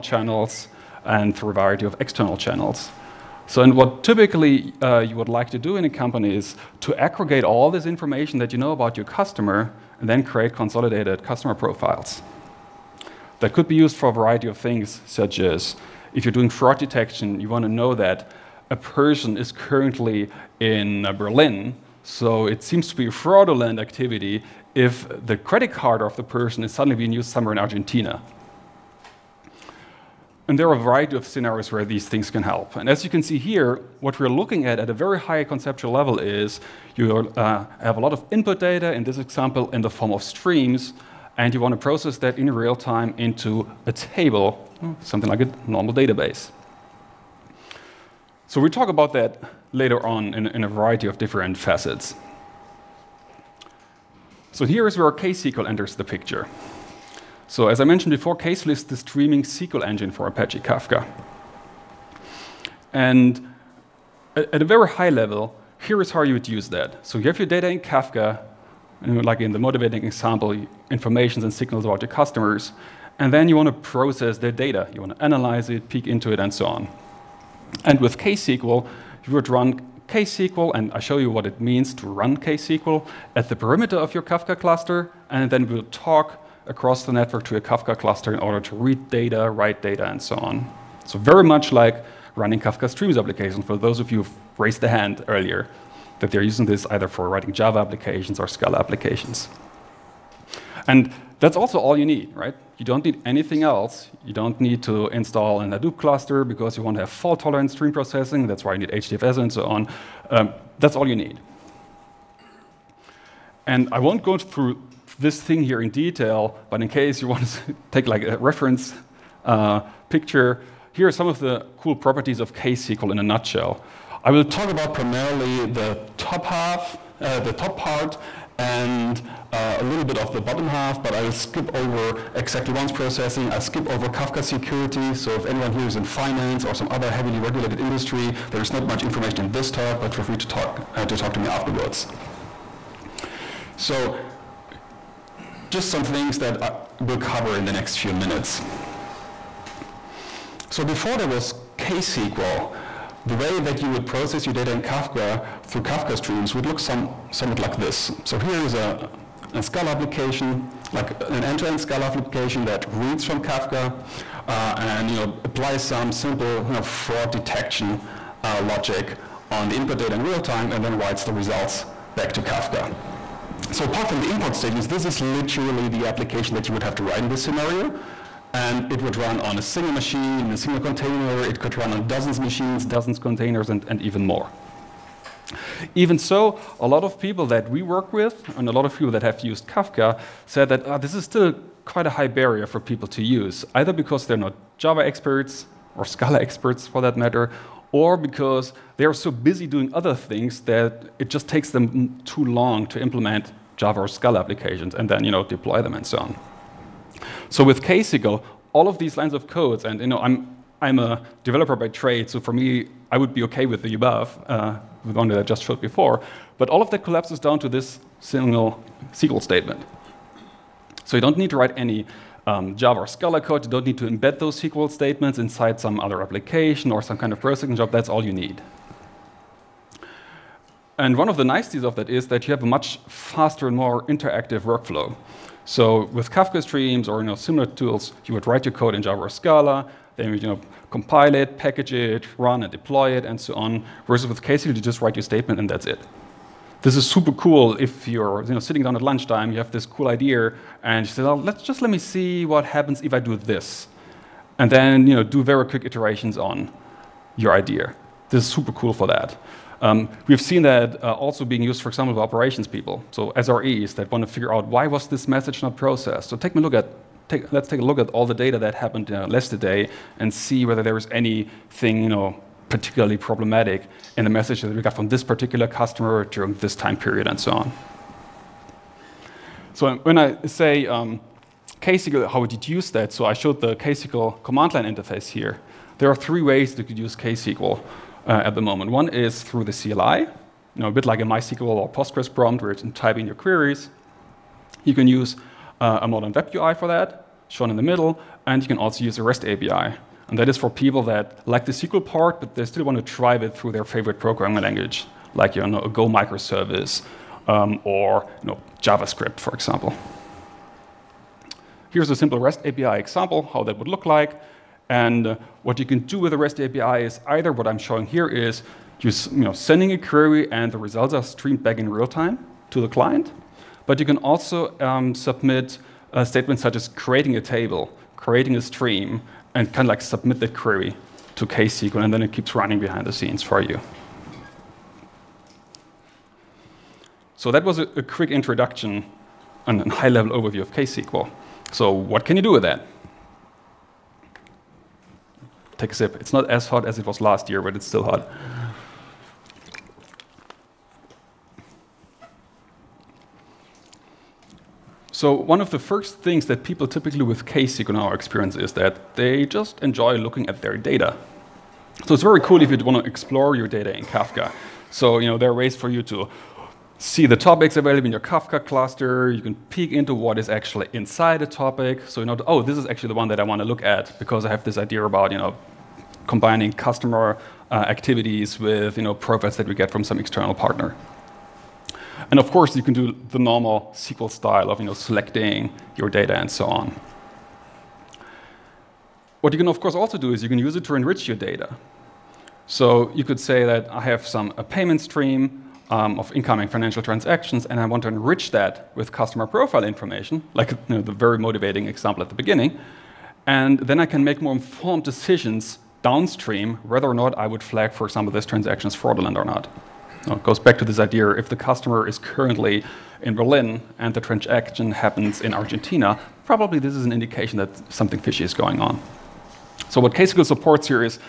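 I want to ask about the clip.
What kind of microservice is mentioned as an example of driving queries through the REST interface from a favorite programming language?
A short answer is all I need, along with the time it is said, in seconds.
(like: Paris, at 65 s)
Go microservice, at 305 s.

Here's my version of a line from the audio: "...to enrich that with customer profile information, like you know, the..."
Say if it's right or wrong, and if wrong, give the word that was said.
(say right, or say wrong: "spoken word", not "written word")
right.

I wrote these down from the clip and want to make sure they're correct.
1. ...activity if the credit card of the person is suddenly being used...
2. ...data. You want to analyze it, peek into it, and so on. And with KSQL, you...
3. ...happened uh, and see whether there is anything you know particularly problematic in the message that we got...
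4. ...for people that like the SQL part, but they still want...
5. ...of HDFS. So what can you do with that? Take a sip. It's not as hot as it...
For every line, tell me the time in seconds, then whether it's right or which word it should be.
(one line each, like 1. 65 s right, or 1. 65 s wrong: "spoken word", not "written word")
1. 23 s right
2. 74 s right
3. 268 s right
4. 300 s right
5. 340 s wrong: "KSQL", not "HDFS".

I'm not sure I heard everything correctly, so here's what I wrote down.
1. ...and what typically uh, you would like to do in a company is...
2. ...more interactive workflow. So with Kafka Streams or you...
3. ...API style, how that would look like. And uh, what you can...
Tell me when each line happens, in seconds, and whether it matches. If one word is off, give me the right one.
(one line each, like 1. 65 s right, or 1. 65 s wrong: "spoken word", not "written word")
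1. 3 s right
2. 233 s right
3. 312 s wrong: "example", not "style".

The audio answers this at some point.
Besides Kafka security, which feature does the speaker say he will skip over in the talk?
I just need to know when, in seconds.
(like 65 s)
132 s.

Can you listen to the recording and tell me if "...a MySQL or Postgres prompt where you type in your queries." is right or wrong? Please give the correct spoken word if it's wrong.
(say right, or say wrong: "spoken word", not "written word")
right.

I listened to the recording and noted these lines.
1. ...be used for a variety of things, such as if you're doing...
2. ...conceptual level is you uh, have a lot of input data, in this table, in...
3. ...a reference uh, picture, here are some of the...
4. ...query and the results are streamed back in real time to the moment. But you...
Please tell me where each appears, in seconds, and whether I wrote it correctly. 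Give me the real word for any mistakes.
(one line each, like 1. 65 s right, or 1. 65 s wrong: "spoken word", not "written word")
1. 13 s right
2. 35 s wrong: "example", not "table"
3. 118 s right
4. 319 s wrong: "client", not "moment".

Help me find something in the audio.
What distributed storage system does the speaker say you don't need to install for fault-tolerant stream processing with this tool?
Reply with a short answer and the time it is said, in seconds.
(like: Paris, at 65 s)
Hadoop, at 105 s.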